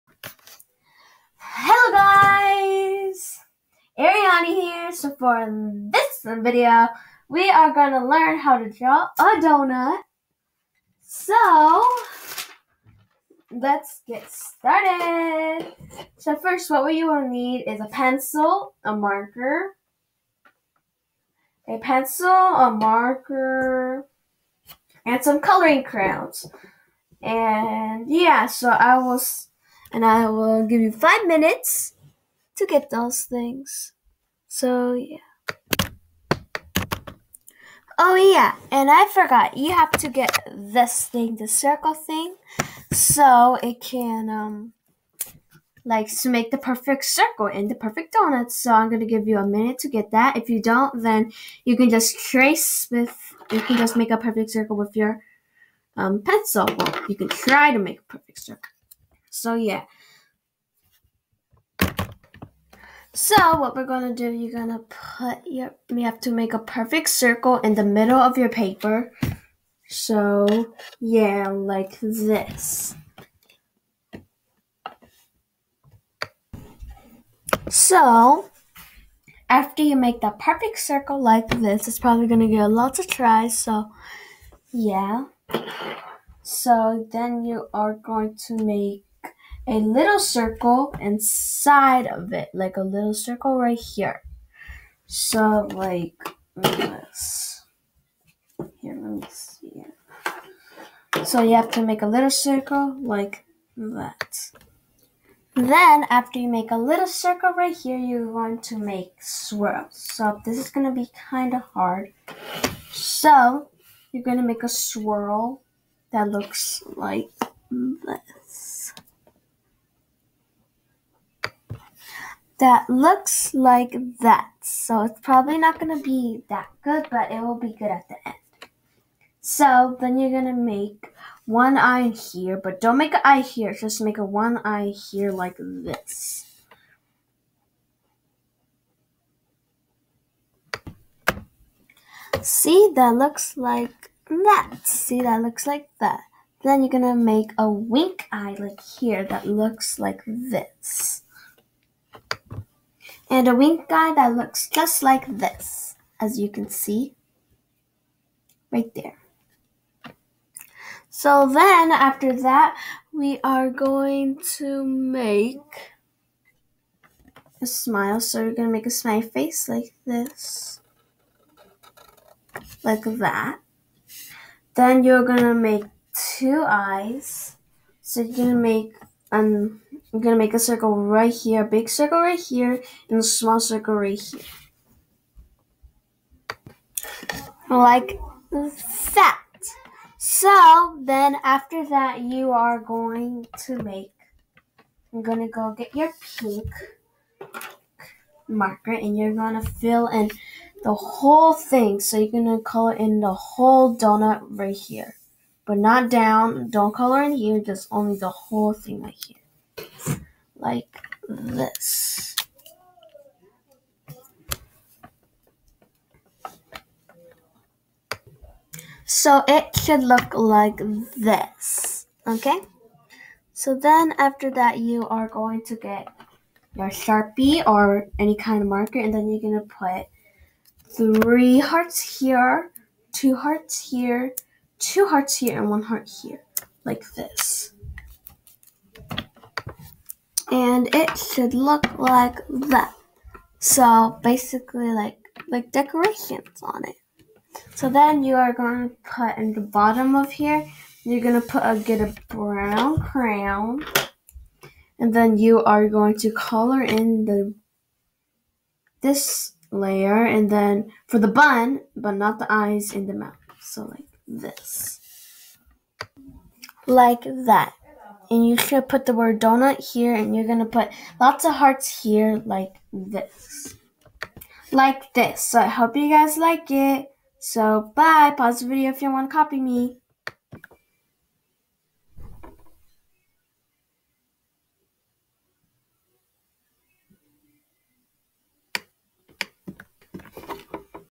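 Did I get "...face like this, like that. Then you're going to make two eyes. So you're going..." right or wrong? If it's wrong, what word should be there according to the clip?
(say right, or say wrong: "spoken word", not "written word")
right.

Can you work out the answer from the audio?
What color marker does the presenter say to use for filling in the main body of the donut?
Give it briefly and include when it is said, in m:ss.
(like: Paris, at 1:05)
Pink, at 3:16.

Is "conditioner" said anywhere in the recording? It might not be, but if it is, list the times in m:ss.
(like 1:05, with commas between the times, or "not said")
not said.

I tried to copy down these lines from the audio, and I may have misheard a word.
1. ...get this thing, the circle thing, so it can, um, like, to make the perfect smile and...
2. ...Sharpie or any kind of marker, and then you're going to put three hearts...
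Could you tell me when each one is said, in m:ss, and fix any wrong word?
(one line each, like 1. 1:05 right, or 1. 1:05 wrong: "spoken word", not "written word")
1. 0:40 wrong: "circle", not "smile"
2. 3:46 right.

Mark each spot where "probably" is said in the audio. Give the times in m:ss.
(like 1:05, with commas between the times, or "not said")
1:21, 2:05.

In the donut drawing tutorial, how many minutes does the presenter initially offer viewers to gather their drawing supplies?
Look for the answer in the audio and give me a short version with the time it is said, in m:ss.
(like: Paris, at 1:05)
5, at 0:30.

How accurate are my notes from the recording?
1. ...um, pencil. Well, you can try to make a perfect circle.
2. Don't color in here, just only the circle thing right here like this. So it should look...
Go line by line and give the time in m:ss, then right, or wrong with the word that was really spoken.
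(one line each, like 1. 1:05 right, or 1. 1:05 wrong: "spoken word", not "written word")
1. 0:55 right
2. 3:26 wrong: "whole", not "circle".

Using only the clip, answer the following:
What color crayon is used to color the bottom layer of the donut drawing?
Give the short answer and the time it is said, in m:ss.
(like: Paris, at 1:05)
Brown, at 4:12.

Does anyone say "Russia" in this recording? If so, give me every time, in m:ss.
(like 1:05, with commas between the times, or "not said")
not said.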